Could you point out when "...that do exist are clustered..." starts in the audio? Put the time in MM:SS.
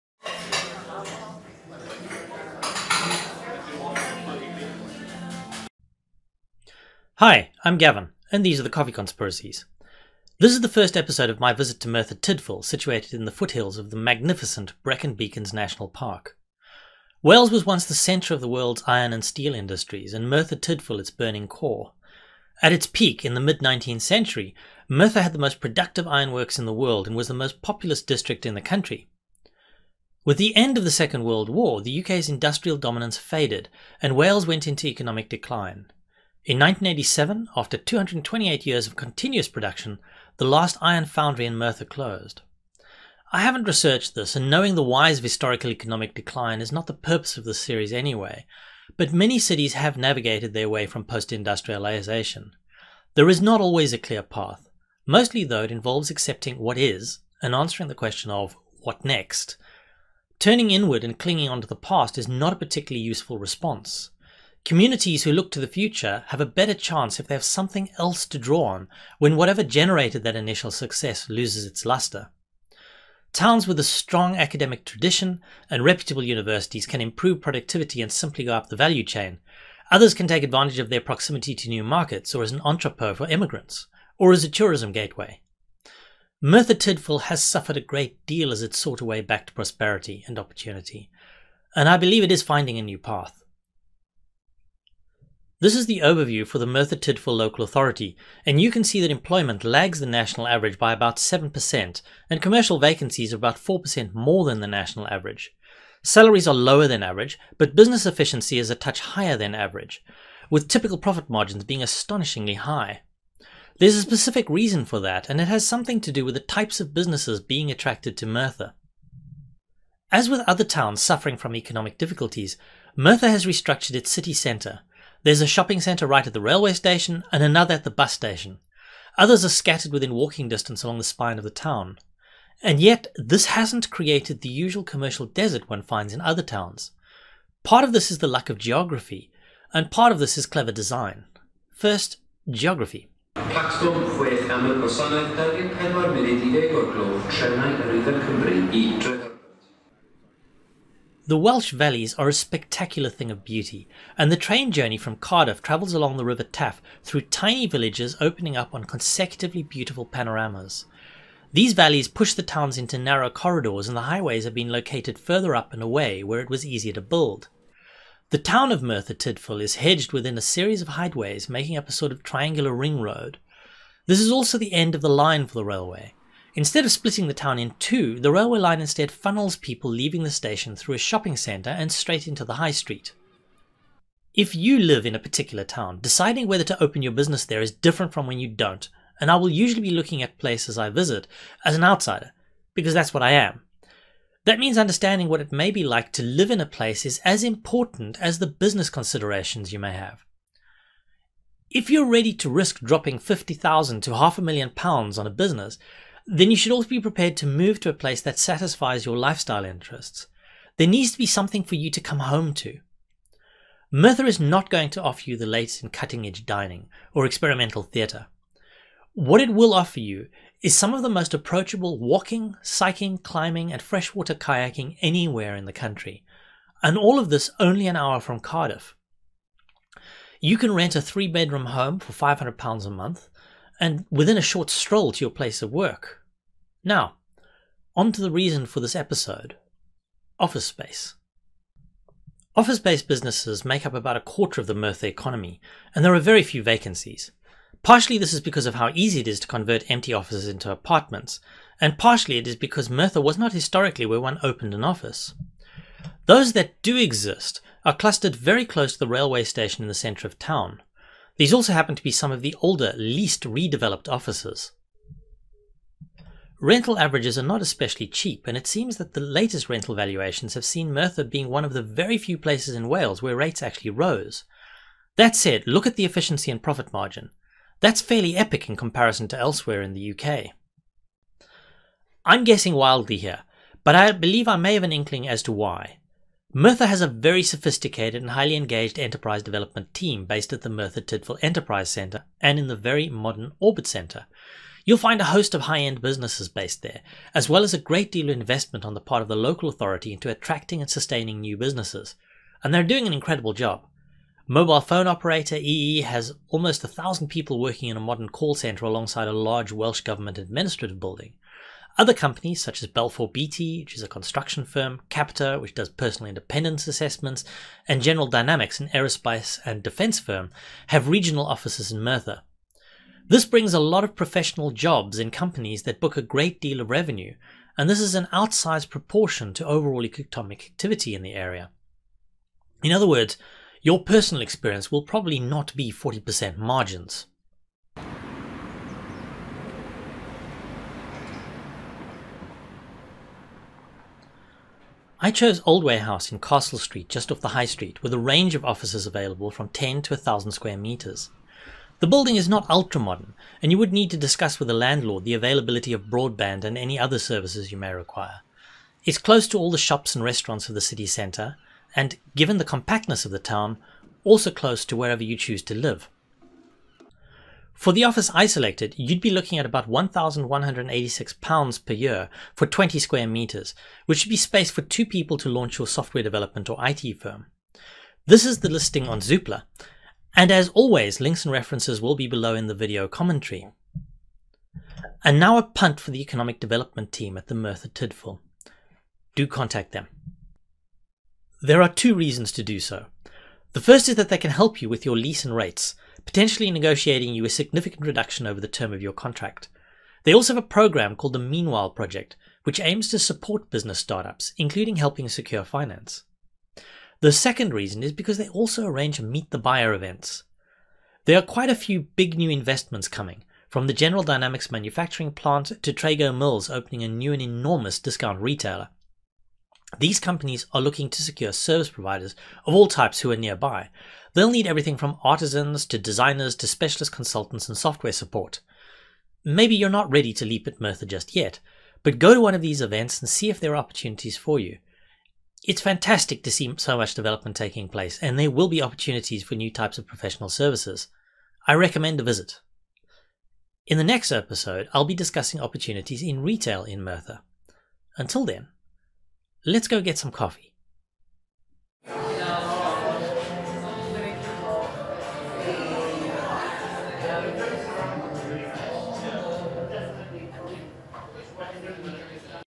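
04:16.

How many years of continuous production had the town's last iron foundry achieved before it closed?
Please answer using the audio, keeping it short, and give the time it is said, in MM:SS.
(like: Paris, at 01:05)
228, at 00:37.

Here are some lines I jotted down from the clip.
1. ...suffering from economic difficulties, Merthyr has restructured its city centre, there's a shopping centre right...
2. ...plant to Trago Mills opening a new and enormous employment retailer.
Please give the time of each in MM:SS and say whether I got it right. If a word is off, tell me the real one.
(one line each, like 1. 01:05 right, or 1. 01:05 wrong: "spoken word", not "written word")
1. 02:01 right
2. 06:55 wrong: "discount", not "employment".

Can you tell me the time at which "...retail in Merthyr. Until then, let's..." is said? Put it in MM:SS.
07:26.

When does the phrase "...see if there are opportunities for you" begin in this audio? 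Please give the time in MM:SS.
07:13.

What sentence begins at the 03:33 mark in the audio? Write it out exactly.
Merthyr is not going to offer you the latest in cutting edge dining or experimental theatre.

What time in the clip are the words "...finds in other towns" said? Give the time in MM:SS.
02:15.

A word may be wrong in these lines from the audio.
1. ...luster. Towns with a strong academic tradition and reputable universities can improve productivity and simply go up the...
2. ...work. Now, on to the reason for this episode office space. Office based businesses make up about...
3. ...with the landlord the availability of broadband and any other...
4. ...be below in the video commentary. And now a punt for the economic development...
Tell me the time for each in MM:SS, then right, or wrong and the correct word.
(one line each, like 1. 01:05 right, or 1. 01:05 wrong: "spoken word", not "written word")
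1. 01:11 right
2. 03:55 right
3. 05:54 right
4. 06:22 right.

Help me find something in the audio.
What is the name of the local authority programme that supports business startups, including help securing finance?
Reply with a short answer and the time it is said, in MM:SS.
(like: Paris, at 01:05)
Meanwhile Project, at 06:41.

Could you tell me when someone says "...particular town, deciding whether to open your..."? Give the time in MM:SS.
03:05.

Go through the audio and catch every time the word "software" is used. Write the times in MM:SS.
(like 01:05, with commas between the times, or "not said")
06:15, 07:07.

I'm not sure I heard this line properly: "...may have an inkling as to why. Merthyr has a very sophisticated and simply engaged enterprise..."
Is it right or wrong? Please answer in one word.
wrong.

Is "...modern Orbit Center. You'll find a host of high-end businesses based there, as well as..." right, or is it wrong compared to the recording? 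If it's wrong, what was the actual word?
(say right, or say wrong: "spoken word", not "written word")
right.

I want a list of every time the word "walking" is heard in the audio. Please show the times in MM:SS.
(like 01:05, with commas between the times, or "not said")
02:10, 03:41.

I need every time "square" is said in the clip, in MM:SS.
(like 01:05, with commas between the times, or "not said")
05:50, 06:12.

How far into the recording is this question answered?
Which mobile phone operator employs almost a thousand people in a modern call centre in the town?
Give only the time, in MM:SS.
05:05.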